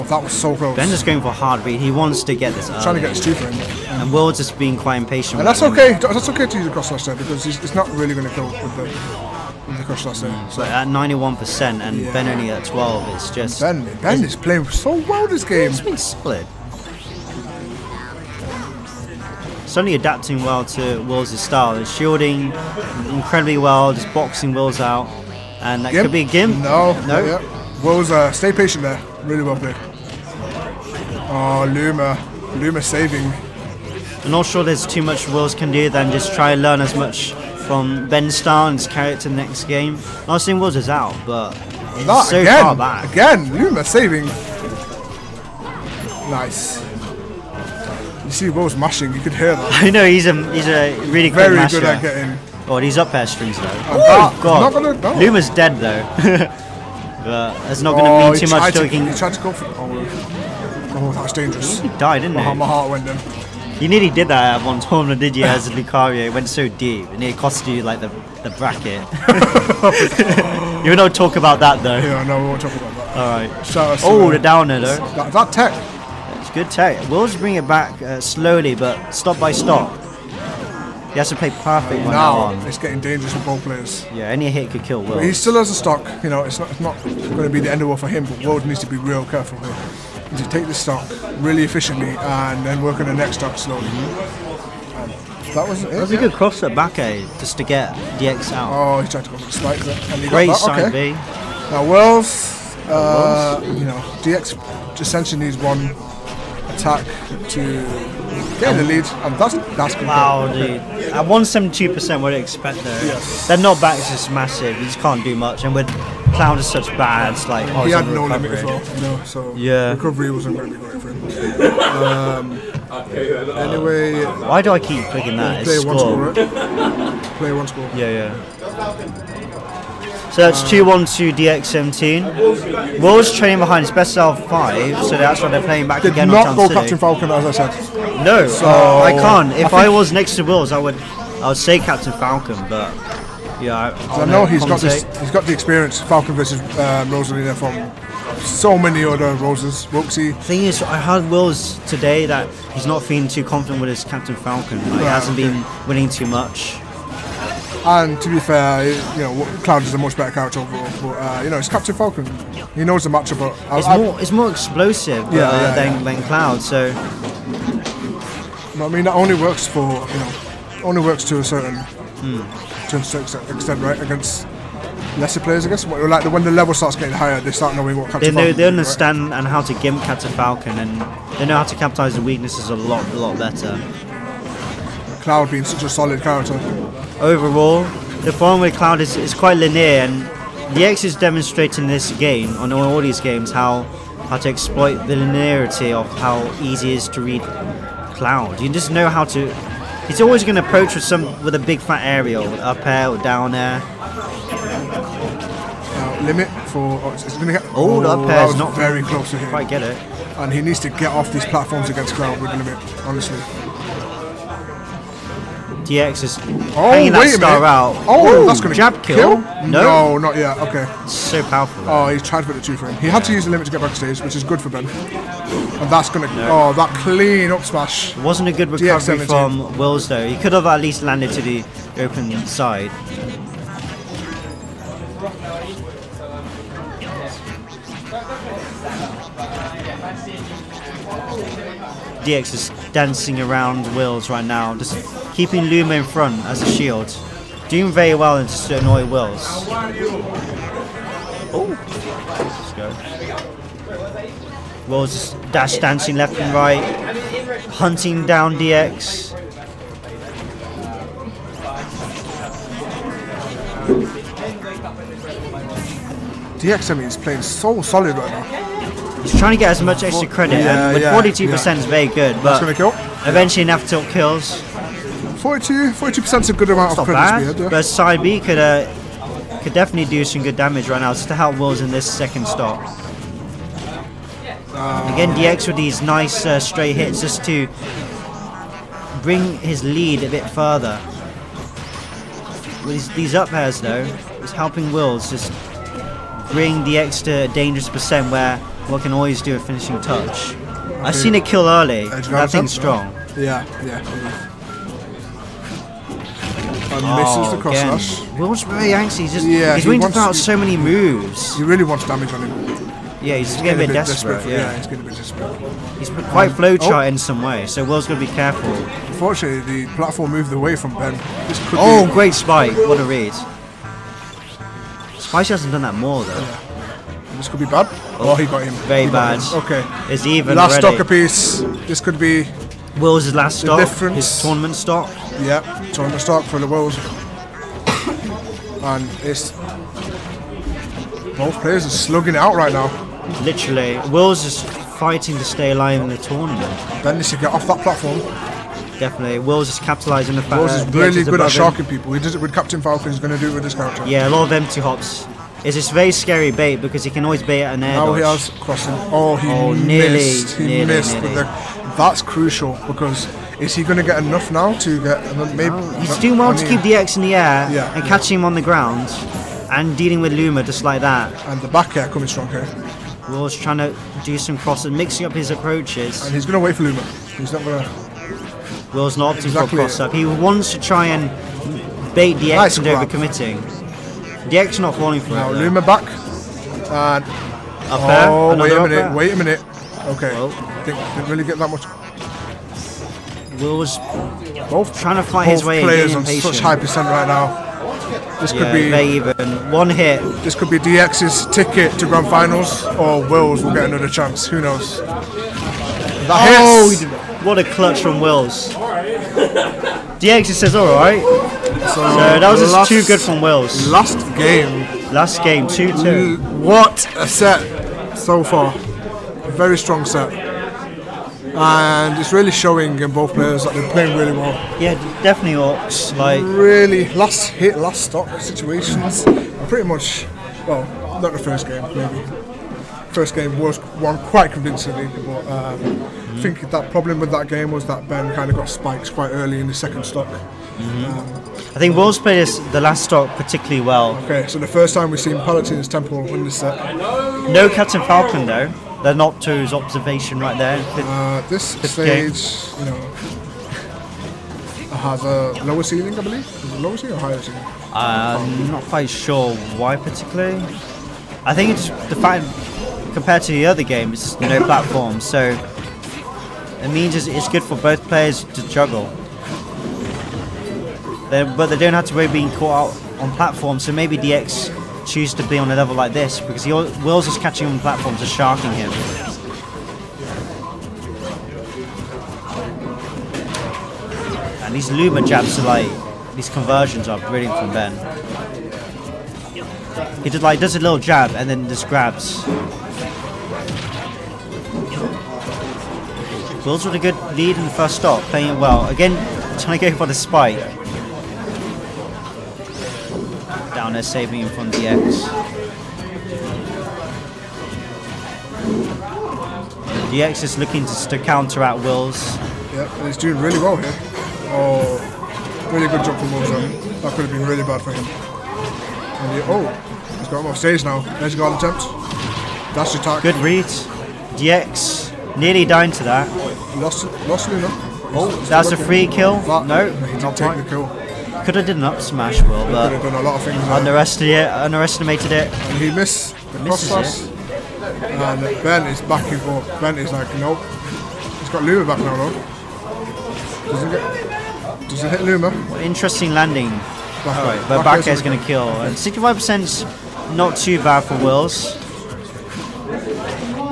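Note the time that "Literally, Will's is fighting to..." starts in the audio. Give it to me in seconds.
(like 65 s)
343 s.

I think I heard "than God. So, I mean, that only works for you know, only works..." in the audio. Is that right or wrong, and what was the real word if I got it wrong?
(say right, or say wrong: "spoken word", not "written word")
wrong: "Cloud", not "God".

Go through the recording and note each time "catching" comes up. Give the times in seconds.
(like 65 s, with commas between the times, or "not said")
368 s, 477 s.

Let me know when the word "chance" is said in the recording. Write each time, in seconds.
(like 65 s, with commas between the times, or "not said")
404 s.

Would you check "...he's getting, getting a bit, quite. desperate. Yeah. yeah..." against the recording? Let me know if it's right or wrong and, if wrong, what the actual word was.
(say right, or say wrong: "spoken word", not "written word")
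wrong: "desperate", not "quite".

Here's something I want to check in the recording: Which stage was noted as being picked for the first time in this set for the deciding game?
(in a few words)
Palutena's Temple.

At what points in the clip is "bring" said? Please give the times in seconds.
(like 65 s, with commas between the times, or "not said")
77 s, 289 s, 296 s.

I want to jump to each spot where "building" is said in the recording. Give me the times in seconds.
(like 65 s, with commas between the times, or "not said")
not said.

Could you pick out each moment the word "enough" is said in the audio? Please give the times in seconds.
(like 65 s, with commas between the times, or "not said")
273 s, 364 s.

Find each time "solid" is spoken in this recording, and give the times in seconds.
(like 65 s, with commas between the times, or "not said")
185 s, 267 s.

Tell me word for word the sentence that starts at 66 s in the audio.
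It went so deep, and it cost you, like, the, the bracket.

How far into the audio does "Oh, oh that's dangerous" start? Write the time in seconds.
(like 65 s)
59 s.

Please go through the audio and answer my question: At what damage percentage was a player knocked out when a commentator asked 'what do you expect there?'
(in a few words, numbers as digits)
172%.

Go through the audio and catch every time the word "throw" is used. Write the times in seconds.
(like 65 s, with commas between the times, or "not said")
310 s.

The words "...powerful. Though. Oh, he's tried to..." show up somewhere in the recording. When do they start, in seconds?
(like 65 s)
221 s.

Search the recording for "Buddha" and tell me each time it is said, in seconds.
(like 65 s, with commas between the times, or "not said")
not said.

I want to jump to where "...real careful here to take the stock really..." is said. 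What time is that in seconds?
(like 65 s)
88 s.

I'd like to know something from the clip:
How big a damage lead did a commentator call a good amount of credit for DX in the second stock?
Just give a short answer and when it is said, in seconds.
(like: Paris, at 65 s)
42%, at 275 s.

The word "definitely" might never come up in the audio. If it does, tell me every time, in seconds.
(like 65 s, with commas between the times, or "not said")
279 s, 348 s, 425 s.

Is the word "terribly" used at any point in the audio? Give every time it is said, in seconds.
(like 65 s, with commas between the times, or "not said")
not said.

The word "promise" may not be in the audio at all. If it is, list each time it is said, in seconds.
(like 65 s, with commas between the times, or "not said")
not said.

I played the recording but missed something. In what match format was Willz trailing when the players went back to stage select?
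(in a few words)
best of 5.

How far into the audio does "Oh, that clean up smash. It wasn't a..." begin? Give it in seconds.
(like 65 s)
226 s.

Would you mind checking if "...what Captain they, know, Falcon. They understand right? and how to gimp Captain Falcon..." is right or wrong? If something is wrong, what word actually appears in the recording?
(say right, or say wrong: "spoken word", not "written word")
right.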